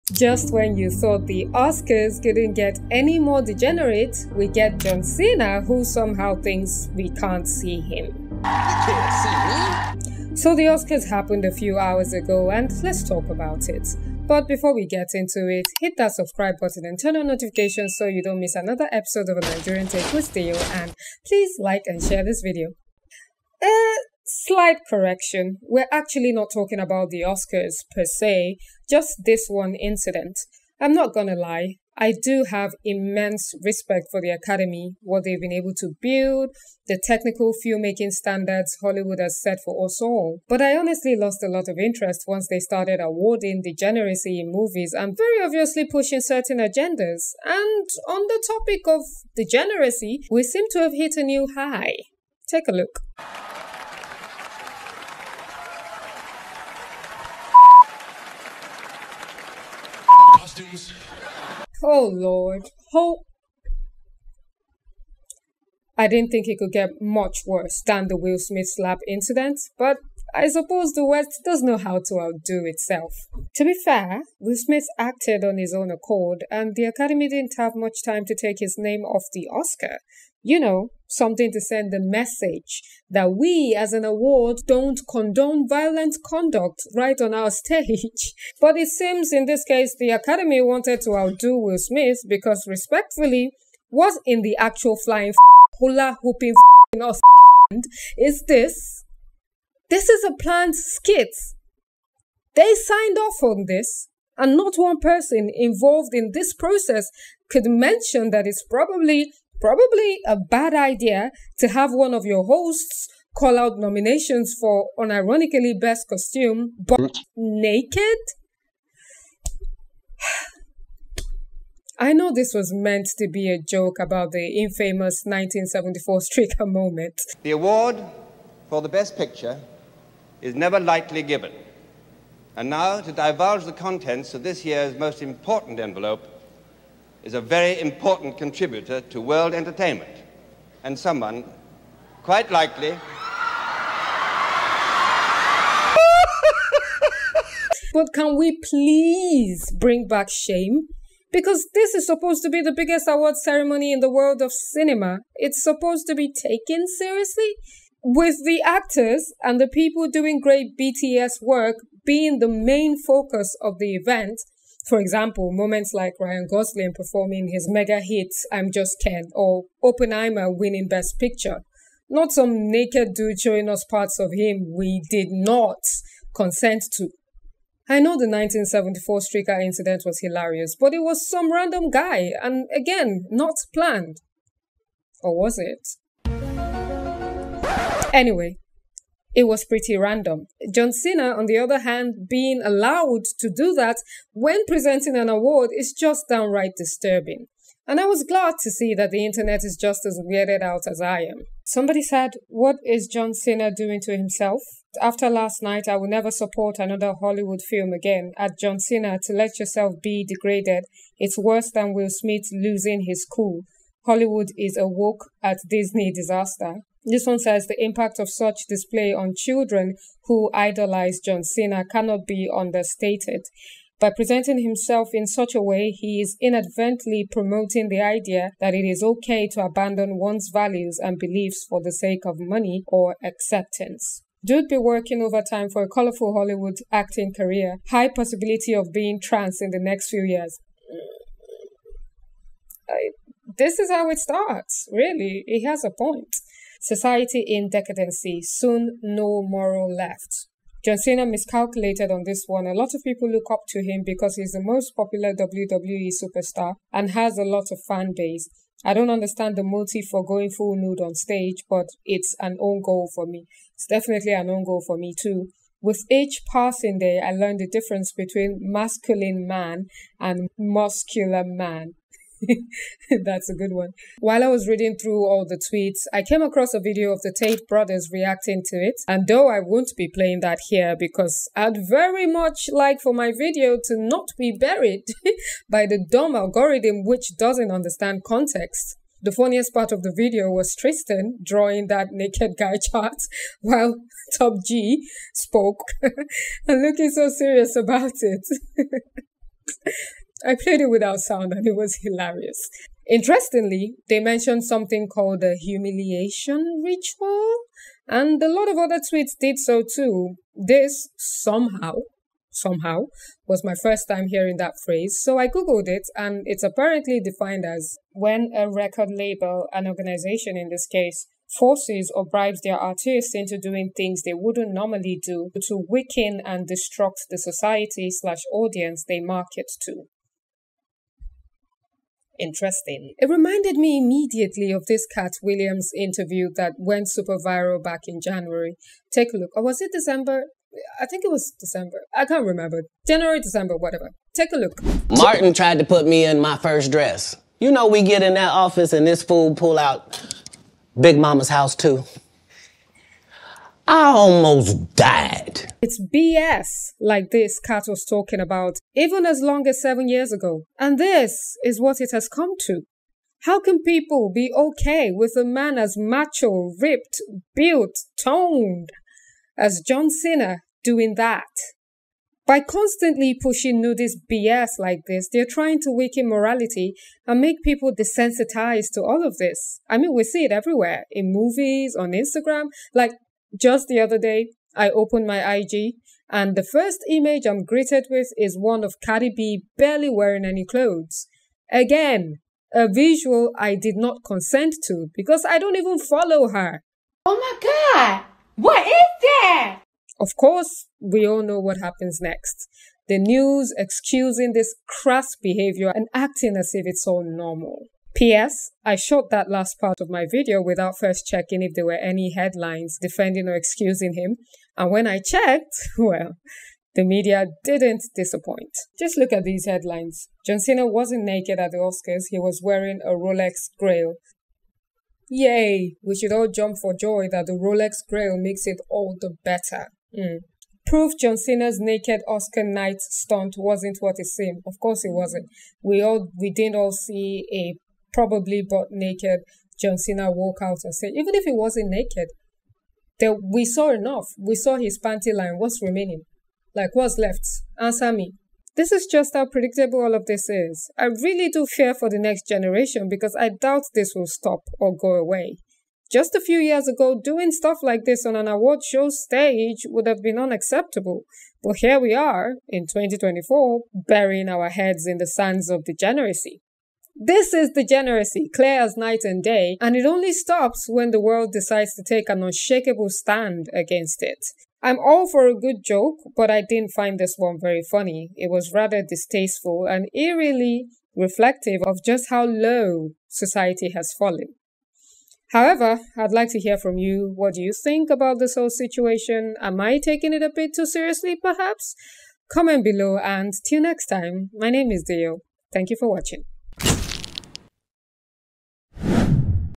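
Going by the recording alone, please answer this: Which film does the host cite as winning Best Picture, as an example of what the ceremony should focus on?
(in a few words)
Oppenheimer.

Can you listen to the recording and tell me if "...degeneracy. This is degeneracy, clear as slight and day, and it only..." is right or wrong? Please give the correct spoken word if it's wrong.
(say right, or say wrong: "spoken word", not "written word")
wrong: "night", not "slight".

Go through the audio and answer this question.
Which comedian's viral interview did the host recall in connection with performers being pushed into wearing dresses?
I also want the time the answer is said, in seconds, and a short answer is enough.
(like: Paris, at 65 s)
Katt Williams, at 335 s.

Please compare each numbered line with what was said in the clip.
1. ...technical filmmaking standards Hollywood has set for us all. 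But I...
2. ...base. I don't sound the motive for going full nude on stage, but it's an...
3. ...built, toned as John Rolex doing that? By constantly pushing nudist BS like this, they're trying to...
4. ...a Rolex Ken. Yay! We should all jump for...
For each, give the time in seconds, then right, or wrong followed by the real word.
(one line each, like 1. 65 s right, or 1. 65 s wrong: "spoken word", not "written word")
1. 37 s right
2. 258 s wrong: "understand", not "sound"
3. 367 s wrong: "Cena", not "Rolex"
4. 423 s wrong: "Grail", not "Ken".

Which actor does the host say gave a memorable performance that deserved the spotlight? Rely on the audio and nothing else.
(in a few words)
Ryan Gosling.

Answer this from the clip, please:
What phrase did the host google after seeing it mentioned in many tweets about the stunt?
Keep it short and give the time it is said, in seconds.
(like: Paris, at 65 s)
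humiliation ritual, at 305 s.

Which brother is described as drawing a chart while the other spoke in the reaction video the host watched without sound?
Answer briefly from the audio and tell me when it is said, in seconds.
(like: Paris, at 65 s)
Tristan, at 290 s.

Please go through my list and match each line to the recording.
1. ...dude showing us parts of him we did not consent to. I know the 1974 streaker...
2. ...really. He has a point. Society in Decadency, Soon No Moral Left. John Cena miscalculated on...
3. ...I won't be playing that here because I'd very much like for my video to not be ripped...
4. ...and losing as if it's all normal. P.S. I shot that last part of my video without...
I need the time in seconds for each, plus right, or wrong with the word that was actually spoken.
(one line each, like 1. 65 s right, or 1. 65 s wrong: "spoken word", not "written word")
1. 173 s right
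2. 244 s right
3. 279 s wrong: "buried", not "ripped"
4. 405 s wrong: "acting", not "losing".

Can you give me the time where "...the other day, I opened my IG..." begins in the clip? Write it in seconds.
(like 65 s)
383 s.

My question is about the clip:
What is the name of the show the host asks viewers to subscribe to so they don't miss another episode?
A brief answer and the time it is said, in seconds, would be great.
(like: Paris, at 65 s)
A Nigerian Take with Deo, at 19 s.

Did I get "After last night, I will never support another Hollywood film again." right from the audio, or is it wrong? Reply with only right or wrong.
right.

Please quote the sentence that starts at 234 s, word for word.
Dude be working overtime for a colorful Hollywood acting career.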